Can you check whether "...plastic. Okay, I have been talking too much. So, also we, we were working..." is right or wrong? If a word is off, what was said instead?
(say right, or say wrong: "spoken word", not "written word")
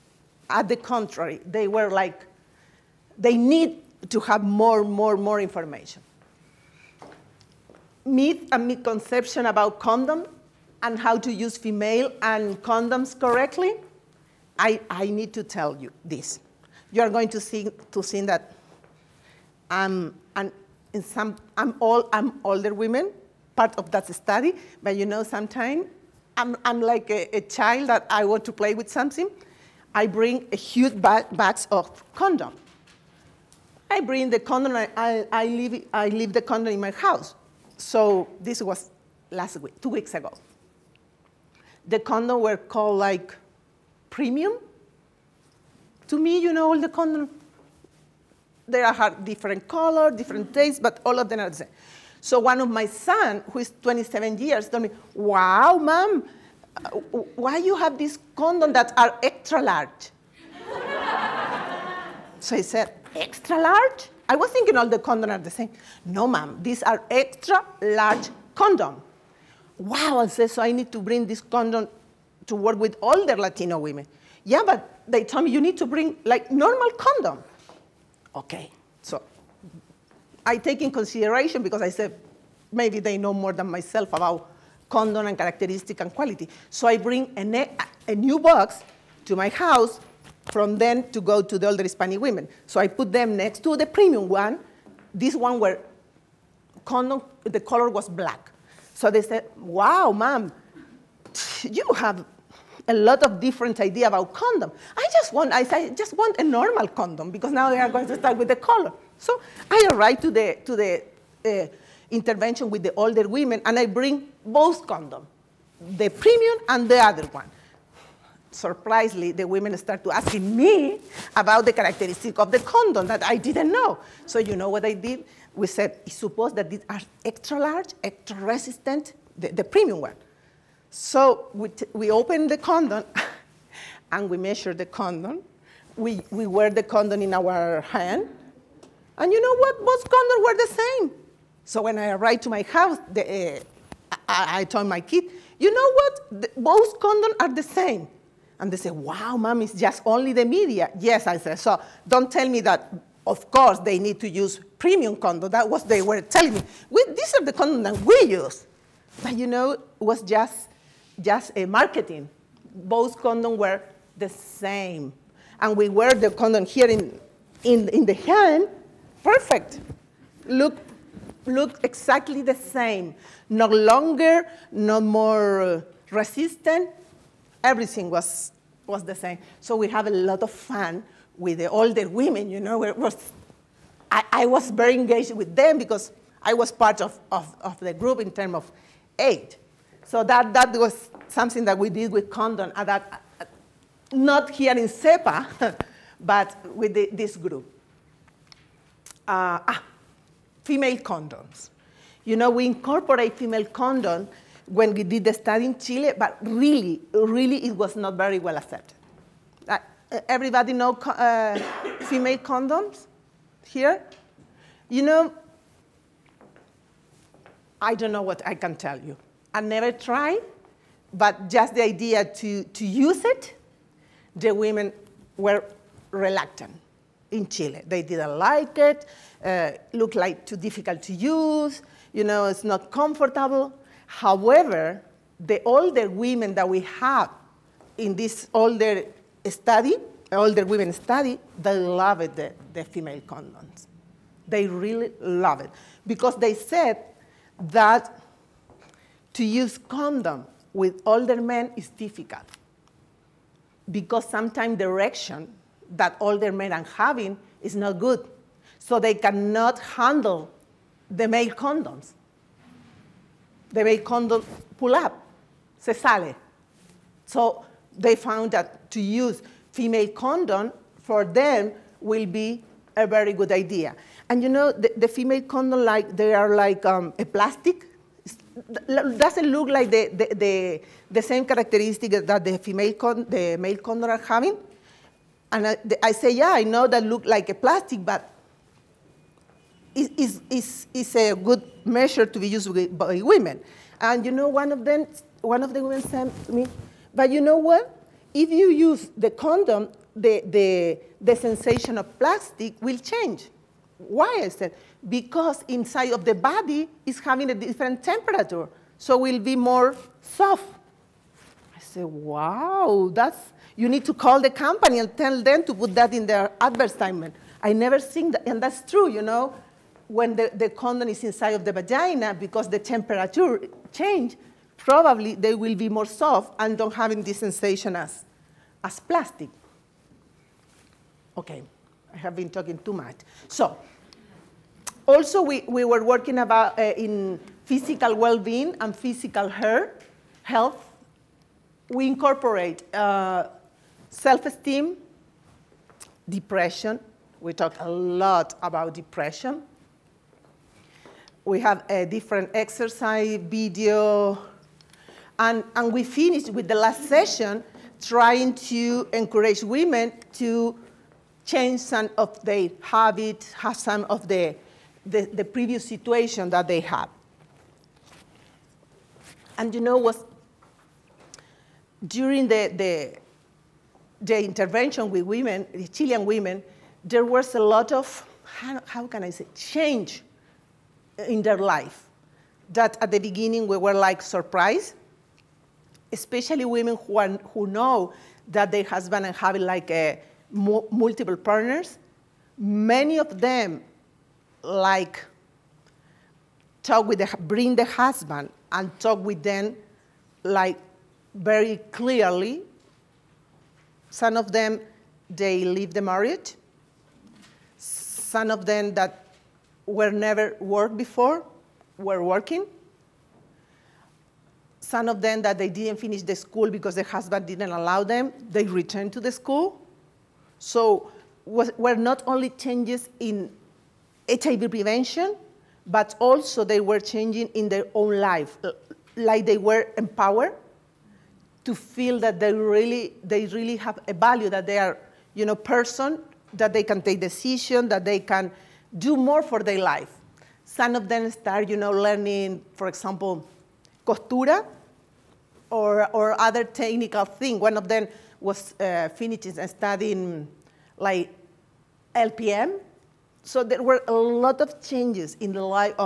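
right.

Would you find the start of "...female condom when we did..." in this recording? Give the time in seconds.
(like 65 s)
203 s.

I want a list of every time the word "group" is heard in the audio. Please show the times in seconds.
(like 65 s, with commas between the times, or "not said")
187 s, 197 s.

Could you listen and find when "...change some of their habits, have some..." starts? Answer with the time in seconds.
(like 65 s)
361 s.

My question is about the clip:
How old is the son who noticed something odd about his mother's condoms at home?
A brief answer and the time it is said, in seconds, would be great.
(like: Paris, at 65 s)
27, at 53 s.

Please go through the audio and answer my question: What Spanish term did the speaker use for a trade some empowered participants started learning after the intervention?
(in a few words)
costura.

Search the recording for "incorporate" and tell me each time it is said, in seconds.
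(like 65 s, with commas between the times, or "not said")
202 s, 342 s.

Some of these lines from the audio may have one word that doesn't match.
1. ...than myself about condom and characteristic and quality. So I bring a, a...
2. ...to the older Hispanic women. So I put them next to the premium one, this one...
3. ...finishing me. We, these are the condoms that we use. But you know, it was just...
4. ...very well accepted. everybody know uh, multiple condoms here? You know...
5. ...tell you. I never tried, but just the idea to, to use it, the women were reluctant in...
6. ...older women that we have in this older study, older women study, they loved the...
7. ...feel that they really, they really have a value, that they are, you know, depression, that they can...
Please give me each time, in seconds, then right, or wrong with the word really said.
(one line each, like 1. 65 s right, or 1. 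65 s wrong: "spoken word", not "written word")
1. 83 s right
2. 91 s right
3. 156 s wrong: "telling", not "finishing"
4. 208 s wrong: "female", not "multiple"
5. 218 s right
6. 235 s right
7. 431 s wrong: "person", not "depression".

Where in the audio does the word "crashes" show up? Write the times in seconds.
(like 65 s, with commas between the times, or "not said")
not said.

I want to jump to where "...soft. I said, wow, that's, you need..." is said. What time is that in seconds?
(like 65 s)
310 s.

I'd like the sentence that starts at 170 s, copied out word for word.
Look look exactly the same, no longer, no more uh, resistant.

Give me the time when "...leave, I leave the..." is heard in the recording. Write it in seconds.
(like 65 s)
35 s.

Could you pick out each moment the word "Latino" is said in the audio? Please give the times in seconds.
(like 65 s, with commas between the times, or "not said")
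73 s.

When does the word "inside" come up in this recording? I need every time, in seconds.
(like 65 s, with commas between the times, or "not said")
305 s, 321 s.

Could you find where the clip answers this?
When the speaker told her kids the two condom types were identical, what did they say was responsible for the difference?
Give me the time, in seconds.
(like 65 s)
150 s.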